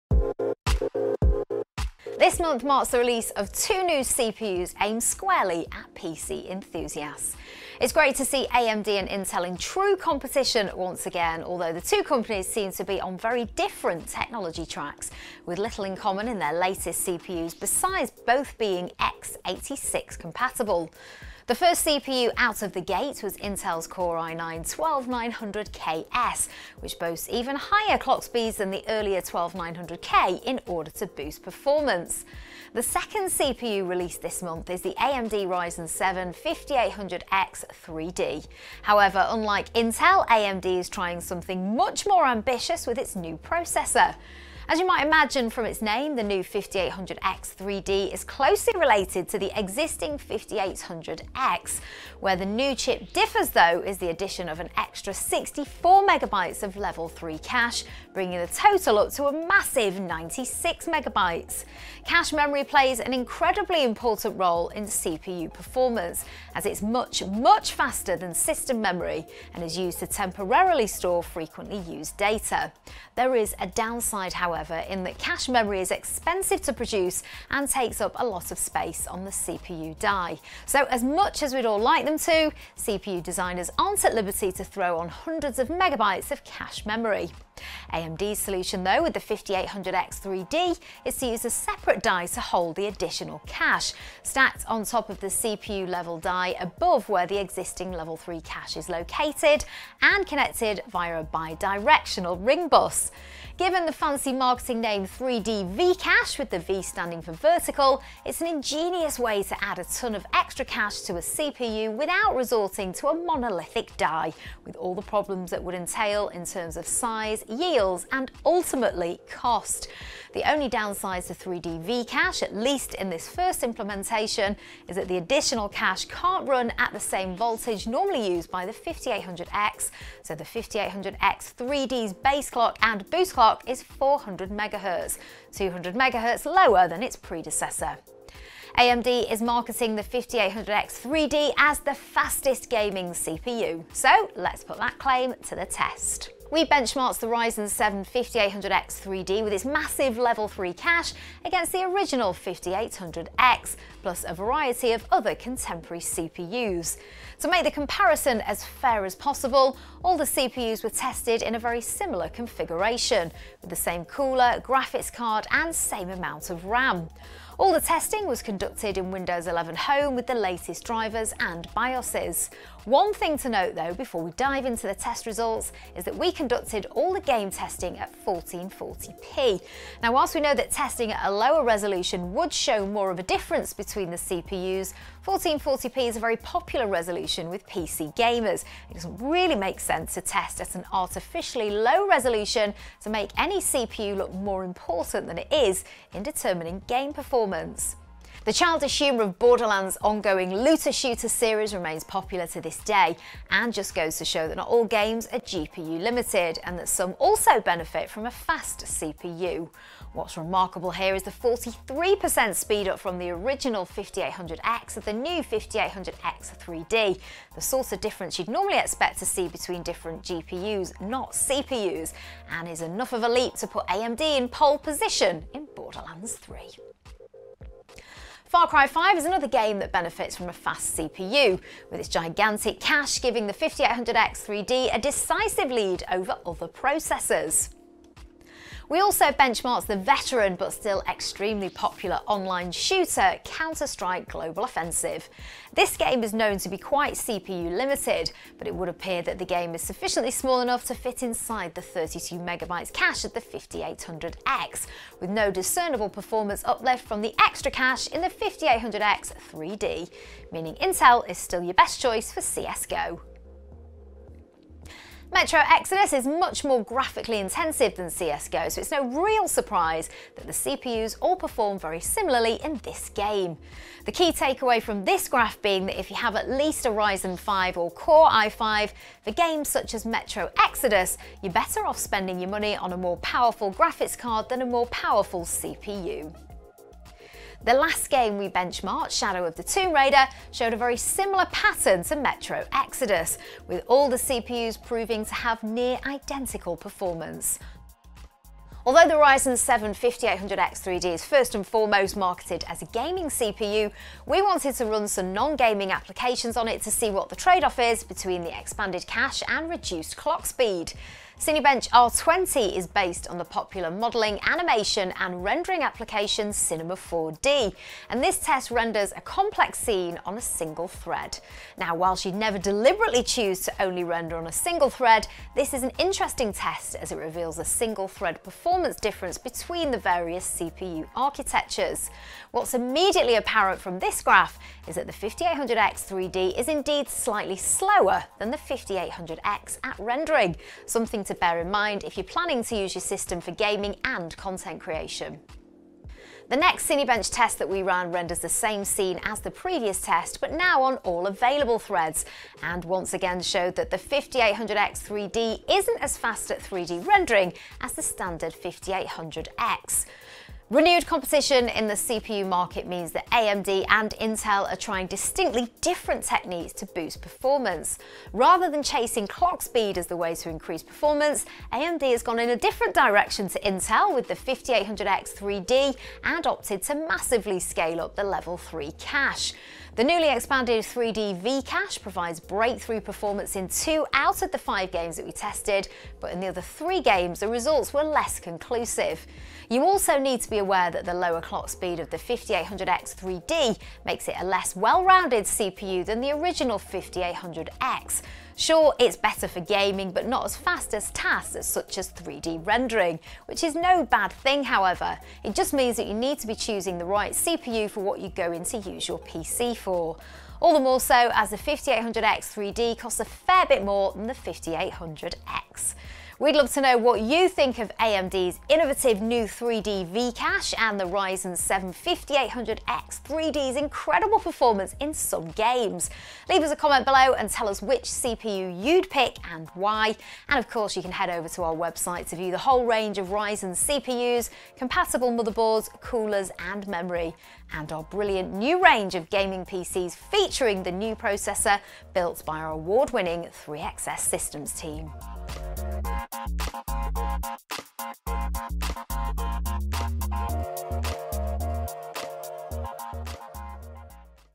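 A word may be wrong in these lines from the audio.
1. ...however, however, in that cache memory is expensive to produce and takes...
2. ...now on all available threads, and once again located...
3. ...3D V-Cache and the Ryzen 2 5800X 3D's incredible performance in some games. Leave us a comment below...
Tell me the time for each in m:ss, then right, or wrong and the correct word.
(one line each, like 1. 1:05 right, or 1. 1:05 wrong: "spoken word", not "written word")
1. 1:14 right
2. 5:50 wrong: "showed", not "located"
3. 6:59 wrong: "7", not "2".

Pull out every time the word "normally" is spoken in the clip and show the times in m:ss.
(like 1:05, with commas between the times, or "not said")
2:07, 3:38.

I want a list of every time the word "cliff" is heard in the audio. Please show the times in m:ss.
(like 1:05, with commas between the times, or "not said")
not said.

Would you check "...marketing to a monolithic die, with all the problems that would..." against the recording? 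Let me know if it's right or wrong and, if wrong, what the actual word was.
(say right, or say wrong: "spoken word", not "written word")
wrong: "resorting", not "marketing".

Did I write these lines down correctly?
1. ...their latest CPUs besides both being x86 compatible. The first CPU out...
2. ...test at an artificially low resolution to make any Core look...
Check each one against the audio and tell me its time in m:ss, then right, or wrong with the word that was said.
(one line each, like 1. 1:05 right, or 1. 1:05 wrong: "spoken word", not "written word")
1. 0:16 right
2. 3:10 wrong: "CPU", not "Core".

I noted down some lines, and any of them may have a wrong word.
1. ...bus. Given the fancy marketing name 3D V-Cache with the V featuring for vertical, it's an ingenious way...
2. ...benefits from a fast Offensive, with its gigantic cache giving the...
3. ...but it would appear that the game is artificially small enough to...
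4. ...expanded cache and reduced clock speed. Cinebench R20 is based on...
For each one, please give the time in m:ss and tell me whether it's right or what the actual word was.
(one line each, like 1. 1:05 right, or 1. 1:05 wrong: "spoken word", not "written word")
1. 1:42 wrong: "standing", not "featuring"
2. 3:49 wrong: "CPU", not "Offensive"
3. 4:08 wrong: "sufficiently", not "artificially"
4. 5:08 right.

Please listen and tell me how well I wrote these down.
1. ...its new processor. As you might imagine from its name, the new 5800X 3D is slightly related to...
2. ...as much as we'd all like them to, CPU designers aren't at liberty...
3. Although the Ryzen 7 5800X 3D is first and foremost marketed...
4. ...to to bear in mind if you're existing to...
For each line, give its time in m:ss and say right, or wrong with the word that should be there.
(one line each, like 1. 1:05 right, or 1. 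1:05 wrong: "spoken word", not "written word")
1. 0:42 wrong: "closely", not "slightly"
2. 1:20 right
3. 4:58 right
4. 5:41 wrong: "planning", not "existing".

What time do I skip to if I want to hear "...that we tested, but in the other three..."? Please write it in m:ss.
6:25.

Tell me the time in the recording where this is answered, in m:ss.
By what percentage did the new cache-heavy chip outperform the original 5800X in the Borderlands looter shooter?
3:31.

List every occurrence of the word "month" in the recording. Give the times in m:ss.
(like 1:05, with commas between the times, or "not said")
0:02, 0:34.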